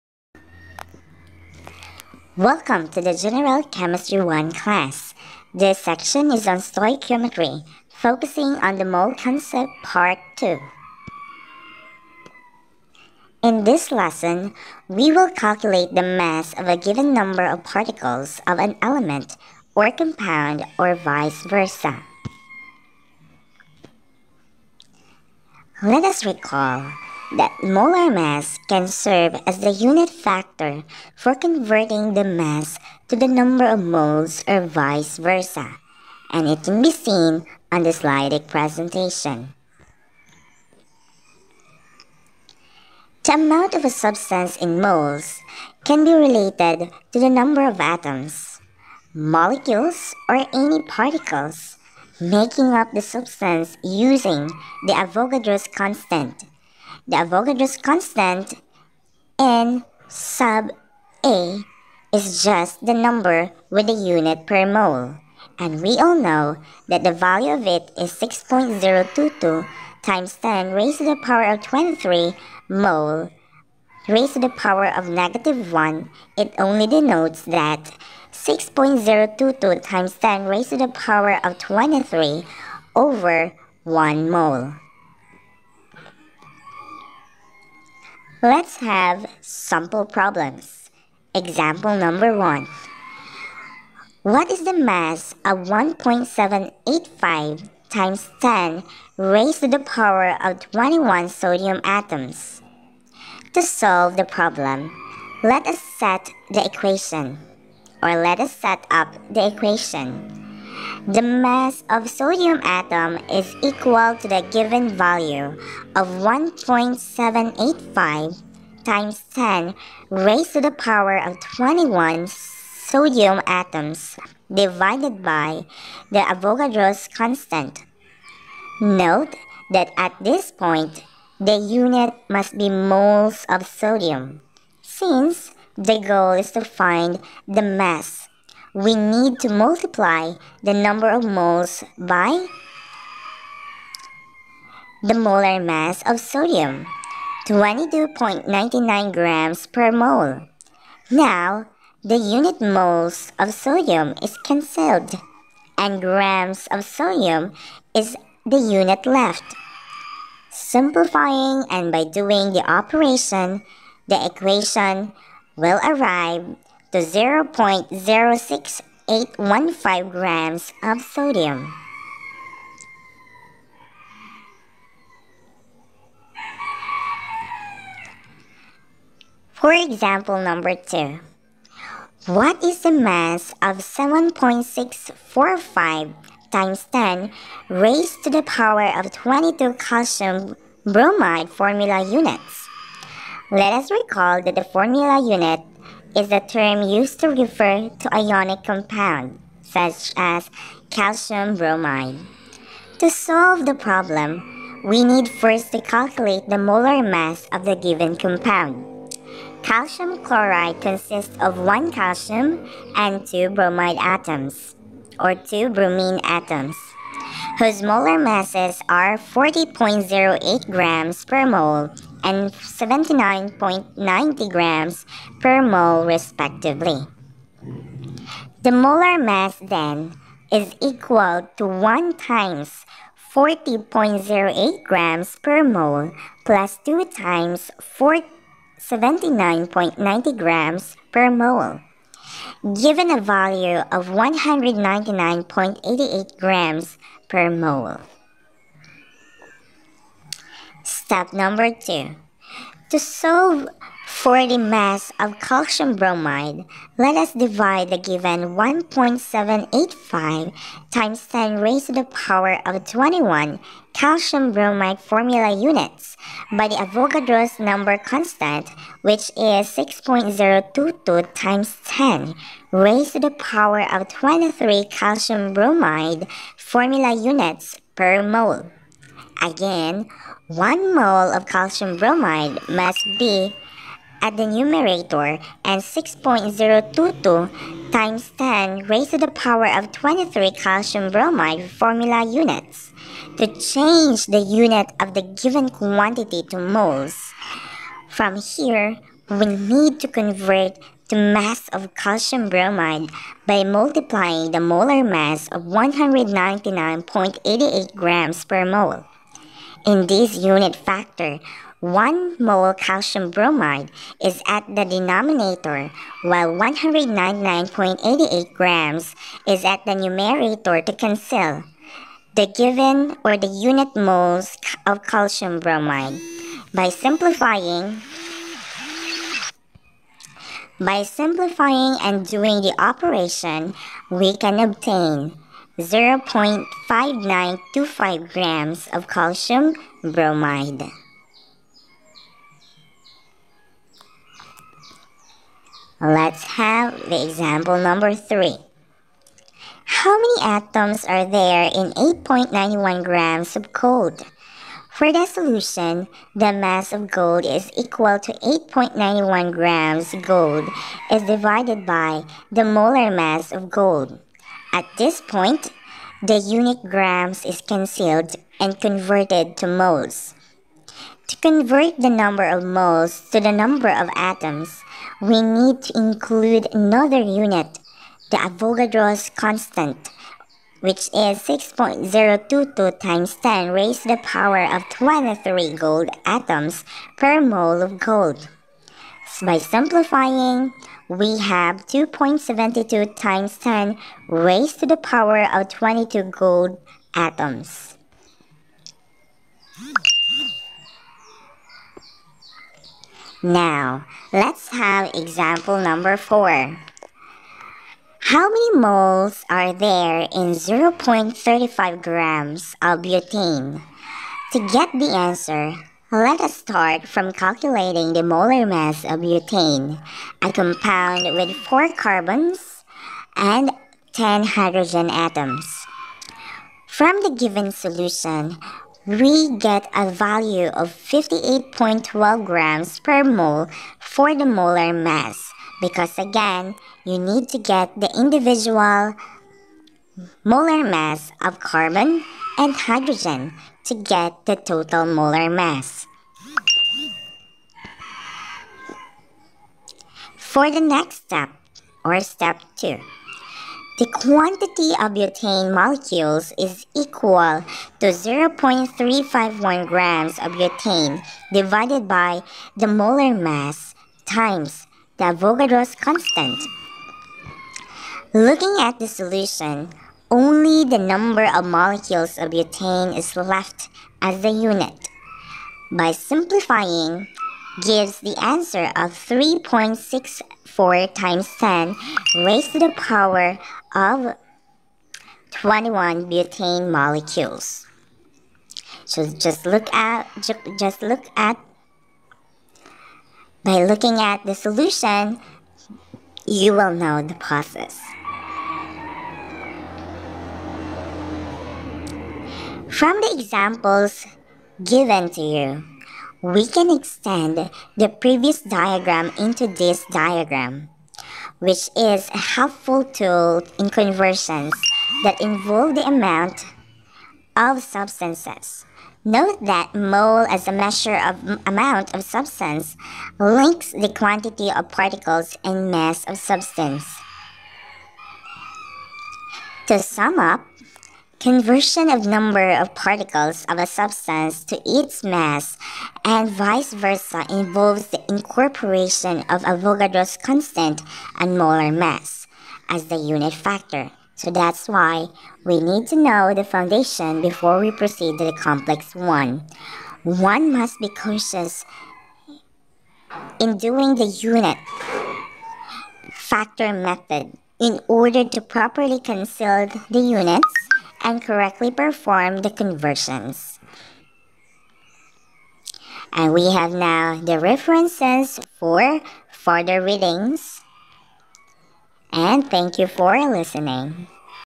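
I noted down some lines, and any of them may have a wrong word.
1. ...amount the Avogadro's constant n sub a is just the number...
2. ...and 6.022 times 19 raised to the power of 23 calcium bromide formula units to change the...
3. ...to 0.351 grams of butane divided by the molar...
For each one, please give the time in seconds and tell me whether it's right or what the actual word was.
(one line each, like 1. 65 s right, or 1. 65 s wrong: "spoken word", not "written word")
1. 55 s wrong: "constant", not "amount"
2. 285 s wrong: "10", not "19"
3. 457 s right.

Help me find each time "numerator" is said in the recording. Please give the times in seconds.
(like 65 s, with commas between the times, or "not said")
284 s, 319 s.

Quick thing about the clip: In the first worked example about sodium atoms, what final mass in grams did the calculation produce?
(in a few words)
0.06815 grams.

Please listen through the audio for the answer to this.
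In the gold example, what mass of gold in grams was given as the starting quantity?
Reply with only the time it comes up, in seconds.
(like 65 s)
351 s.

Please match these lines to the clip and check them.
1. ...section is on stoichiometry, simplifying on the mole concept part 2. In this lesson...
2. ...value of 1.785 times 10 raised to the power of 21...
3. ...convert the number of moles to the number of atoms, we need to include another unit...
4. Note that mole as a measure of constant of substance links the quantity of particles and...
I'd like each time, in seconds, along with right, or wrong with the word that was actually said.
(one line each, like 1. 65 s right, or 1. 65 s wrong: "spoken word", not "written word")
1. 5 s wrong: "focusing", not "simplifying"
2. 114 s right
3. 371 s right
4. 519 s wrong: "amount", not "constant".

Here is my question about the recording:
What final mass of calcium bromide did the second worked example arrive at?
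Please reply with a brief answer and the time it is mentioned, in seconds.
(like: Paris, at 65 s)
0.5925 grams, at 335 s.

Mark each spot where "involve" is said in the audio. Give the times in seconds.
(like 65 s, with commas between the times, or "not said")
515 s, 537 s.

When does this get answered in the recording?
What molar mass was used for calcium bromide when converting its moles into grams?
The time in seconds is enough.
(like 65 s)
305 s.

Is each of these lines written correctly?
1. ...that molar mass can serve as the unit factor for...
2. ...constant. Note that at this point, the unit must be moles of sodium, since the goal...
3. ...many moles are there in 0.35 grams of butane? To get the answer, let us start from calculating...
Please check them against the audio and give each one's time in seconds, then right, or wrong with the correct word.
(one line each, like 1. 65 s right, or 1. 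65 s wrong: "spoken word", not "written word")
1. 27 s right
2. 127 s right
3. 408 s right.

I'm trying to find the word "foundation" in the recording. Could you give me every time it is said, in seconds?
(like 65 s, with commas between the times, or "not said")
546 s.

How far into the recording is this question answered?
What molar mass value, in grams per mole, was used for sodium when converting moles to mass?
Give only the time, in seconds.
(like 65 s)
147 s.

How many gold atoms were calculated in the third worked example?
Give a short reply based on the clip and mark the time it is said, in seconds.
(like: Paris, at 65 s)
2.72 × 10^22, at 391 s.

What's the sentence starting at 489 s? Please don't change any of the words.
So just look at just look at by looking at the solution, you will know the process.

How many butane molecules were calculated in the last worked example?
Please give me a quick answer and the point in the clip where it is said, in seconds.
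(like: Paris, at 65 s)
3.64 × 10^21, at 479 s.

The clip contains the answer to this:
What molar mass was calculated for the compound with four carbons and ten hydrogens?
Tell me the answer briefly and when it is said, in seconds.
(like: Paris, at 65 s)
58.12 grams per mole, at 430 s.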